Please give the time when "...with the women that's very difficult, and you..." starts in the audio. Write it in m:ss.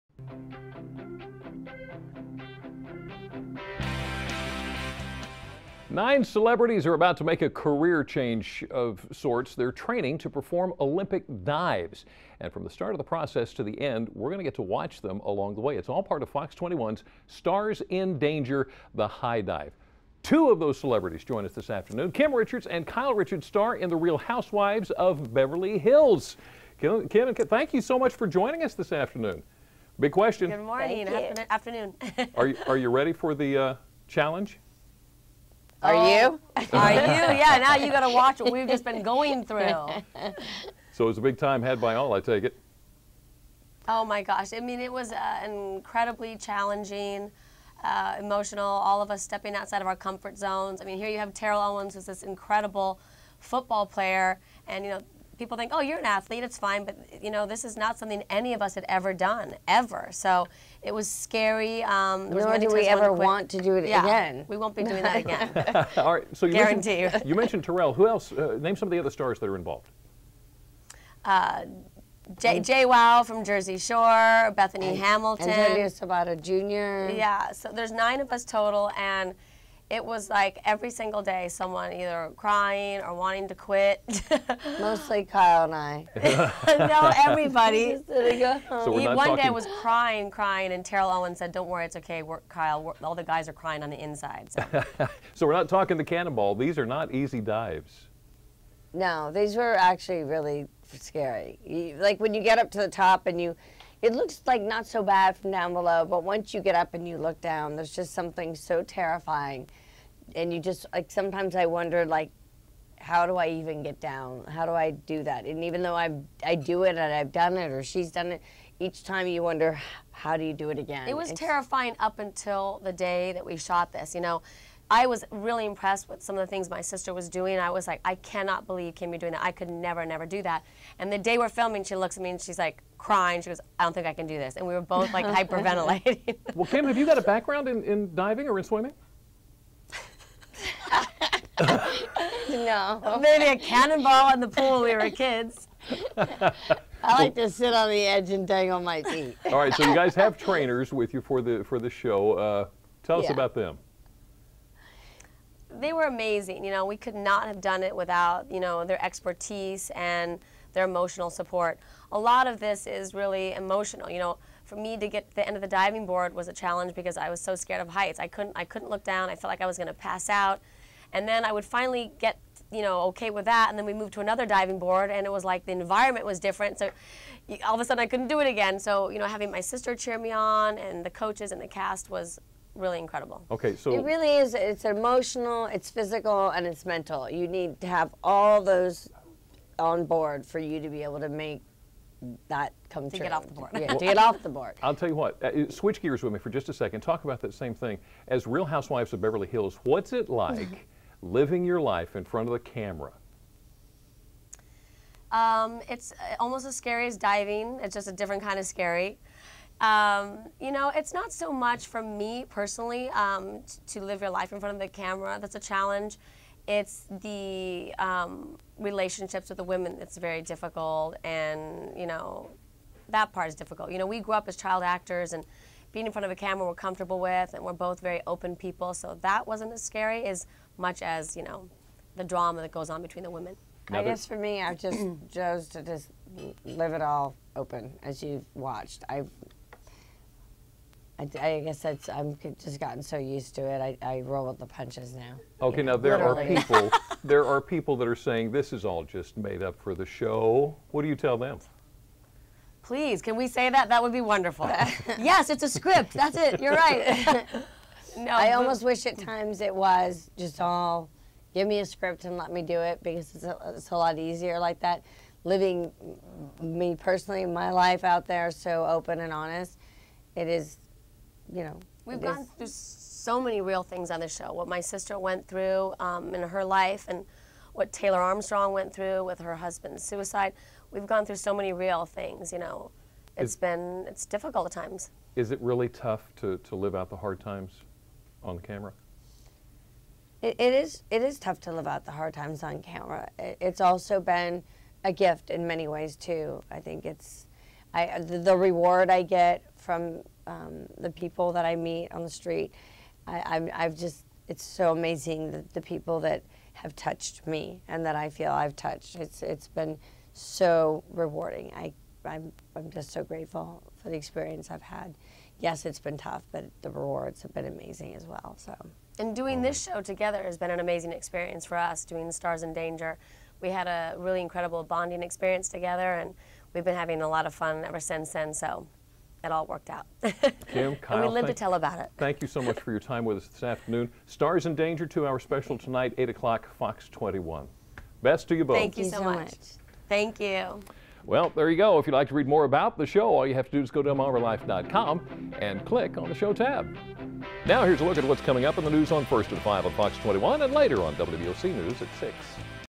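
3:39.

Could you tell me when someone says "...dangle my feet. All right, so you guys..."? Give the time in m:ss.
2:28.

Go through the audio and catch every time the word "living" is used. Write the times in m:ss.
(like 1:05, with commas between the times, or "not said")
3:21, 4:25.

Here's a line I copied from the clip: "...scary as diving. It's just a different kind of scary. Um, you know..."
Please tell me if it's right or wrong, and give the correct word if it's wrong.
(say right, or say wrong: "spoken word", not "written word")
right.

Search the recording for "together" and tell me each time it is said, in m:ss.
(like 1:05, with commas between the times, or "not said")
5:20, 5:25.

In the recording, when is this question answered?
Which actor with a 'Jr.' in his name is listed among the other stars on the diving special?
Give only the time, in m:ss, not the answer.
1:15.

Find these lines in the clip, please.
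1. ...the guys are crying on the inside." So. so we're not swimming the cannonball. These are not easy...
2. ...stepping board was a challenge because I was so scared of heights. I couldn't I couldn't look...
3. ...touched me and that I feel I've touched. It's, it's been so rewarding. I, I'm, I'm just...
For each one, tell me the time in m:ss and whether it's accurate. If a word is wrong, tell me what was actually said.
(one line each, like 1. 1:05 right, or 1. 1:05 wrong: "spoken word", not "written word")
1. 1:33 wrong: "talking", not "swimming"
2. 2:45 wrong: "diving", not "stepping"
3. 5:06 right.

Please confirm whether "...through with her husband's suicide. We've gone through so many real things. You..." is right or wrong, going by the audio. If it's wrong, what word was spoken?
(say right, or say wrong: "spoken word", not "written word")
right.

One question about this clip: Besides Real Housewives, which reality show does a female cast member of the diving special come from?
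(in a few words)
Jersey Shore.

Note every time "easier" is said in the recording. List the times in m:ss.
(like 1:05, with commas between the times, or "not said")
4:24.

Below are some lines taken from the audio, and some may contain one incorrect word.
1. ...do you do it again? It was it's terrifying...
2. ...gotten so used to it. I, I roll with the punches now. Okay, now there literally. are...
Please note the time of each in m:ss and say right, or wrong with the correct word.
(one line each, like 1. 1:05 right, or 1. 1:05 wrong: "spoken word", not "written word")
1. 2:00 right
2. 4:02 right.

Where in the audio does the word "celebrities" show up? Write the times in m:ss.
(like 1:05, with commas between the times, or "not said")
0:06, 0:20.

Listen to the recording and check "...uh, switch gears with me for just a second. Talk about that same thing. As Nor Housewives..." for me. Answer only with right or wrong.
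wrong.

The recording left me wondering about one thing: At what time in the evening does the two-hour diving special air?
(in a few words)
8 o'clock.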